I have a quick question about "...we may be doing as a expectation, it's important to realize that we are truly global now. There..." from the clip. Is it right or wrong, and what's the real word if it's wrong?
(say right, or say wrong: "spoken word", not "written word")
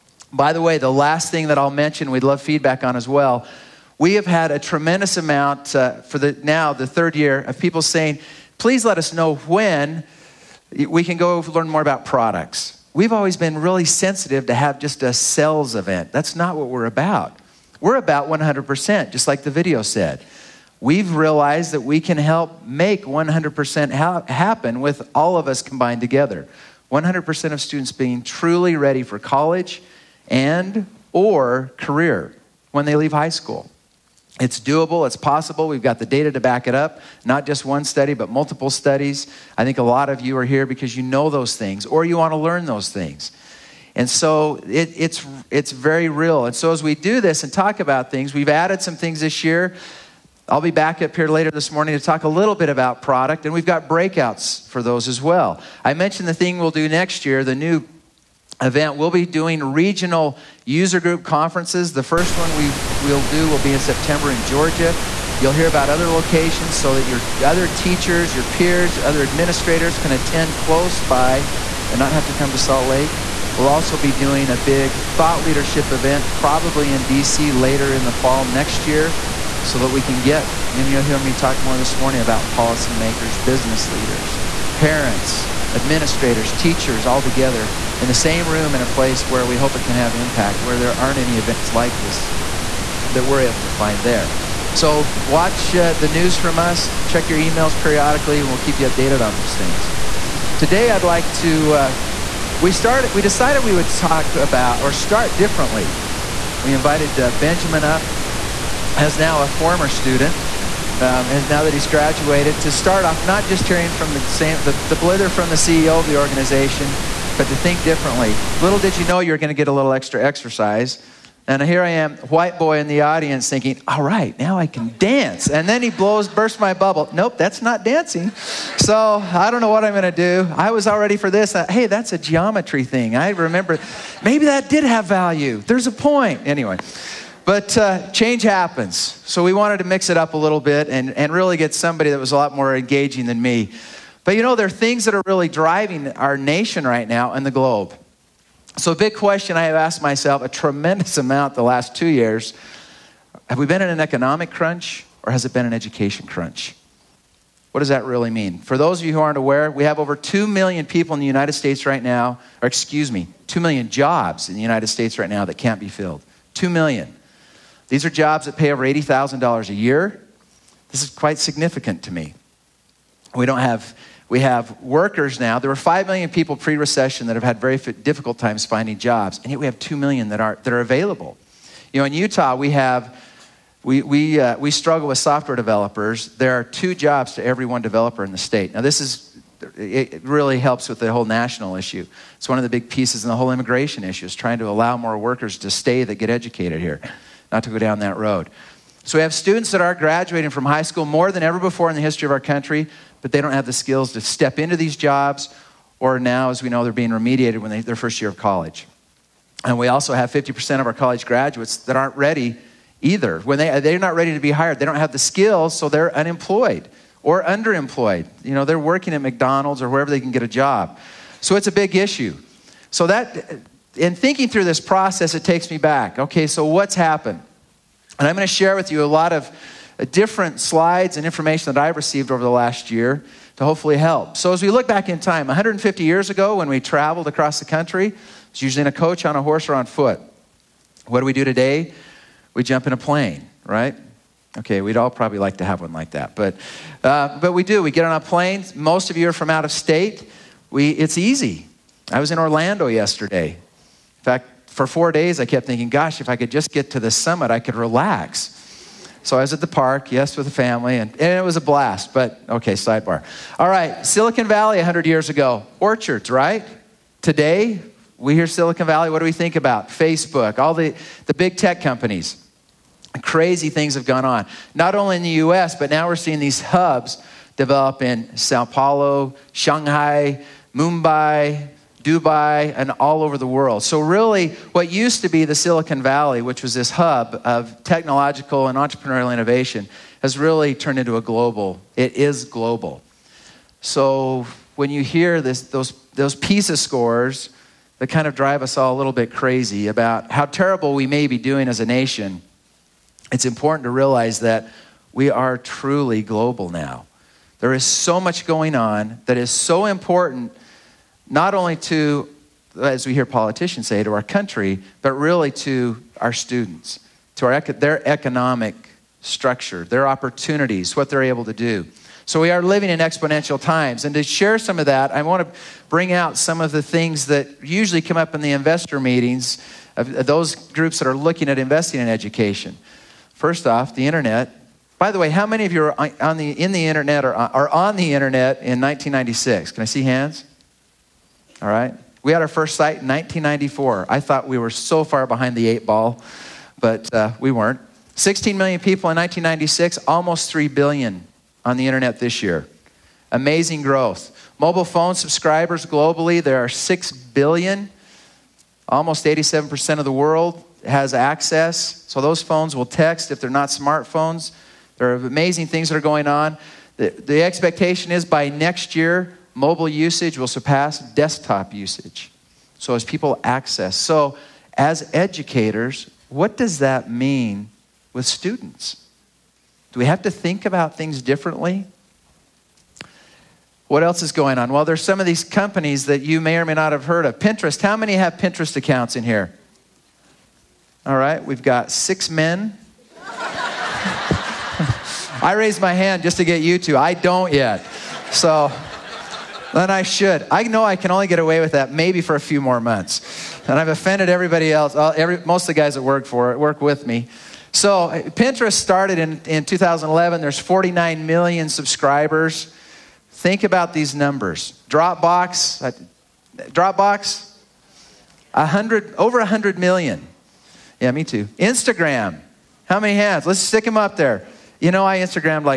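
wrong: "nation", not "expectation".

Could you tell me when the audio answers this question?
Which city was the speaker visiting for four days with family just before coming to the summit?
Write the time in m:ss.
4:12.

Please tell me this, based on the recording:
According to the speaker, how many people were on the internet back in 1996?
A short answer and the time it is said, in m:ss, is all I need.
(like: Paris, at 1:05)
16 million, at 5:48.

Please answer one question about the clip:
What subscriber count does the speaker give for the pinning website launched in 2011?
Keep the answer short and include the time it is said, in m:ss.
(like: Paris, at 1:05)
49 million, at 6:50.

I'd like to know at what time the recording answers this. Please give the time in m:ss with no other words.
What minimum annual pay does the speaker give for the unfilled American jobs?
2:48.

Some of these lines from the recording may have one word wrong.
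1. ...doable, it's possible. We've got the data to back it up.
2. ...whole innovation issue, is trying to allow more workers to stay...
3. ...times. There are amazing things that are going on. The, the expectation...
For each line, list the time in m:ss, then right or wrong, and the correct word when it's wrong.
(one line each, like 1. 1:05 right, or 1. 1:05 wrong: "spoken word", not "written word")
1. 0:34 right
2. 3:13 wrong: "immigration", not "innovation"
3. 6:03 wrong: "smartphones", not "times".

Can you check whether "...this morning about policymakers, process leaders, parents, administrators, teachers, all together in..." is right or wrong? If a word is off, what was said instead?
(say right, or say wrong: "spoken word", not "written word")
wrong: "business", not "process".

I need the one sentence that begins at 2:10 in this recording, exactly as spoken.
I was all ready for this.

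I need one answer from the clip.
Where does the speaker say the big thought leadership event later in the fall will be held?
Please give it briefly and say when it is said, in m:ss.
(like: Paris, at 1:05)
DC, at 1:17.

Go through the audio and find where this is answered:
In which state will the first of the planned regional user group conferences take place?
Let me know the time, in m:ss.
1:04.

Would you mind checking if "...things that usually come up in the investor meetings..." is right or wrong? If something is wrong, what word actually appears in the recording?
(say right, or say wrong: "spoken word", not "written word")
right.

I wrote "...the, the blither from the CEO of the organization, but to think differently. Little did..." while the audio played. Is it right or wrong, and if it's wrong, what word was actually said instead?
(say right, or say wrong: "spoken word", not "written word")
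right.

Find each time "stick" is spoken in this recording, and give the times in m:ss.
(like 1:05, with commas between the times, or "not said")
7:03.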